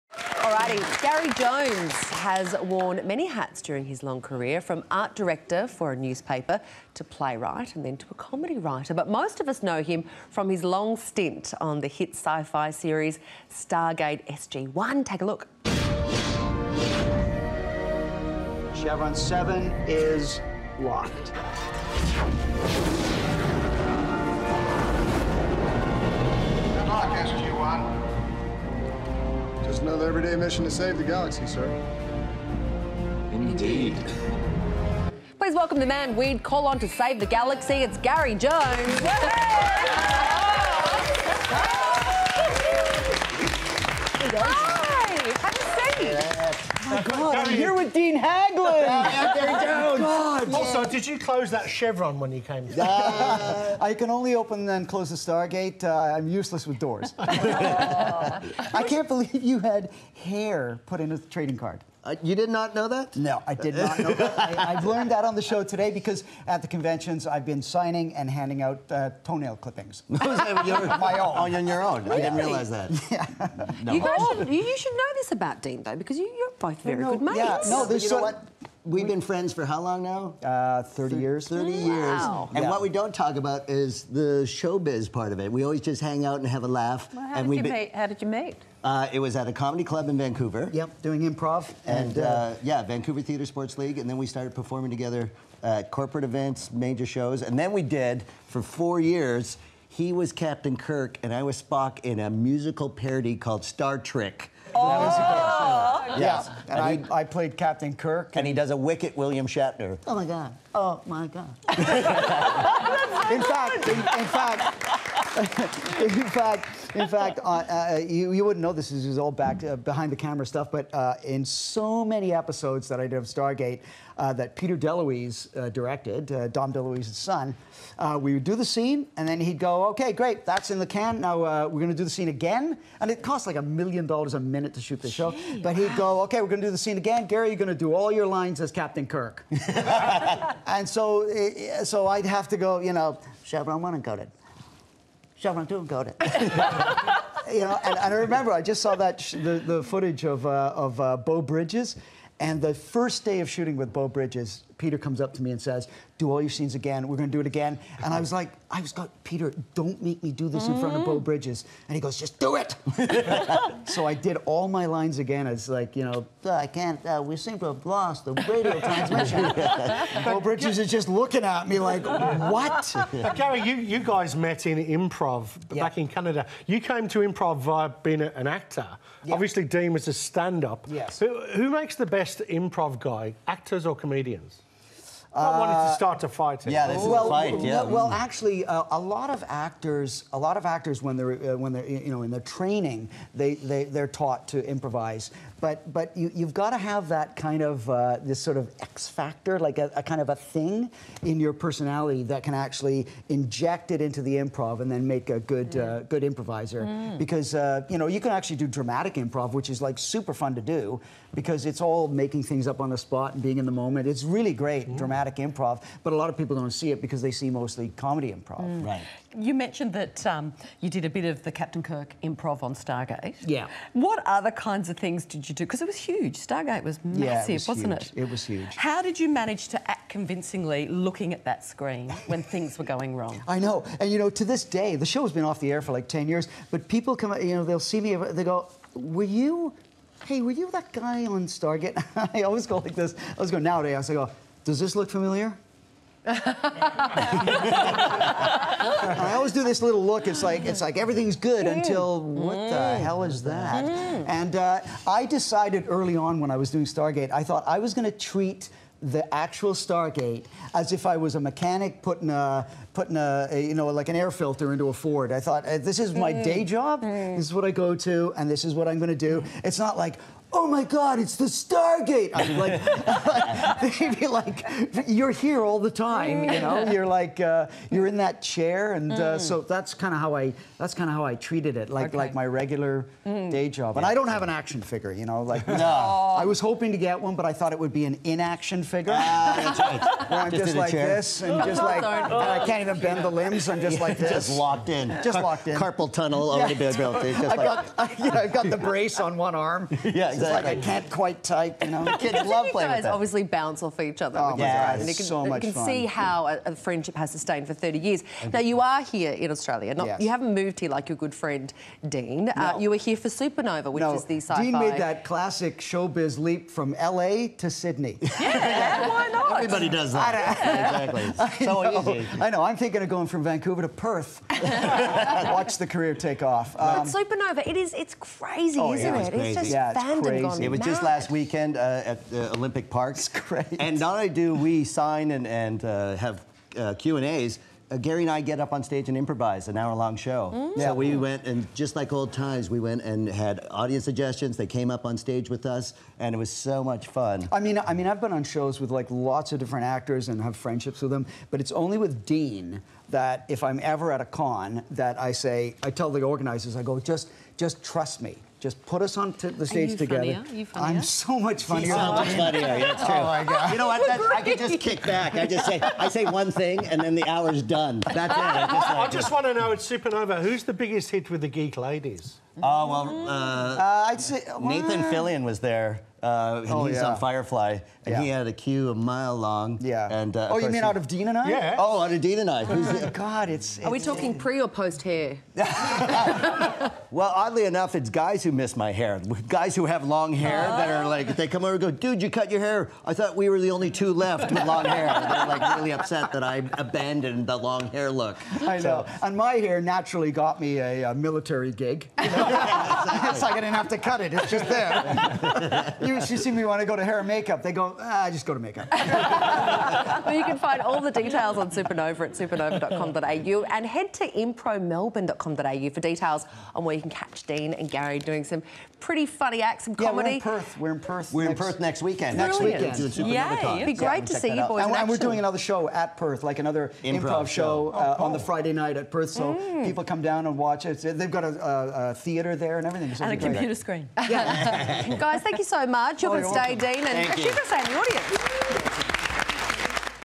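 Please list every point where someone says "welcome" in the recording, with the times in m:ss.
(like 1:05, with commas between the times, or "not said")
0:35, 7:16.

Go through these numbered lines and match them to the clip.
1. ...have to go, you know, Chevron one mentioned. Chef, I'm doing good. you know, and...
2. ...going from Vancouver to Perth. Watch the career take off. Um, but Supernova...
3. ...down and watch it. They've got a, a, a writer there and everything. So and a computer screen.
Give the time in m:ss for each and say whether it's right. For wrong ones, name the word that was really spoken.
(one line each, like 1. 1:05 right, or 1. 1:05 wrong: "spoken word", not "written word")
1. 2:22 wrong: "encoded", not "mentioned"
2. 5:23 right
3. 7:10 wrong: "theater", not "writer".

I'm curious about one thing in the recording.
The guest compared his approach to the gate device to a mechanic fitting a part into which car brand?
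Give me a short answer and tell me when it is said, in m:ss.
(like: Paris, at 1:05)
Ford, at 4:24.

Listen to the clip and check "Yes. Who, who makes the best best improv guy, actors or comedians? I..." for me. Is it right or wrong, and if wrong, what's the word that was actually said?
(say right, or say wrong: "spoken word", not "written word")
right.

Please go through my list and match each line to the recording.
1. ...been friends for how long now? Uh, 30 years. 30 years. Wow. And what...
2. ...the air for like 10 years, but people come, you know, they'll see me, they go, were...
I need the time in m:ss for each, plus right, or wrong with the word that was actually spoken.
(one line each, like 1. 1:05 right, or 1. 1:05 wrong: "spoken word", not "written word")
1. 1:19 right
2. 3:55 right.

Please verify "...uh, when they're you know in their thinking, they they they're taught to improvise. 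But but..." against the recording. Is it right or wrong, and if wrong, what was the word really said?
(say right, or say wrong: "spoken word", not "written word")
wrong: "training", not "thinking".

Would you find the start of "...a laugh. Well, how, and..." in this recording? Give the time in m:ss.
1:26.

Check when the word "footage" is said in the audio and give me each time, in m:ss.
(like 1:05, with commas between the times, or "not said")
2:29.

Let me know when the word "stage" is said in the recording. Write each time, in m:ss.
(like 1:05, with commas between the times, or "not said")
5:38, 5:45, 5:59.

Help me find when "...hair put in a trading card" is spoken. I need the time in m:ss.
1:00.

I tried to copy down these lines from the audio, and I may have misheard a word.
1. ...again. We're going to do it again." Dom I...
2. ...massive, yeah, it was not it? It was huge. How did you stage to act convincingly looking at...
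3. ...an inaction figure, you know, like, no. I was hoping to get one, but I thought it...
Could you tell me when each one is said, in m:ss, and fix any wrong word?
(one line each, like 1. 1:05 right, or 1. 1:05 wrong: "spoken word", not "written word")
1. 2:36 wrong: "And", not "Dom"
2. 3:47 wrong: "manage", not "stage"
3. 4:44 wrong: "action", not "inaction".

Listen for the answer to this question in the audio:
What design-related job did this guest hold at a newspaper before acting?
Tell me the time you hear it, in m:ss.
0:04.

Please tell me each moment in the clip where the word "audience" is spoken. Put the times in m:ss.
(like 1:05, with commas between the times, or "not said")
5:43, 7:17.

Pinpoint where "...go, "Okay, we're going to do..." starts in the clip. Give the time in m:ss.
2:15.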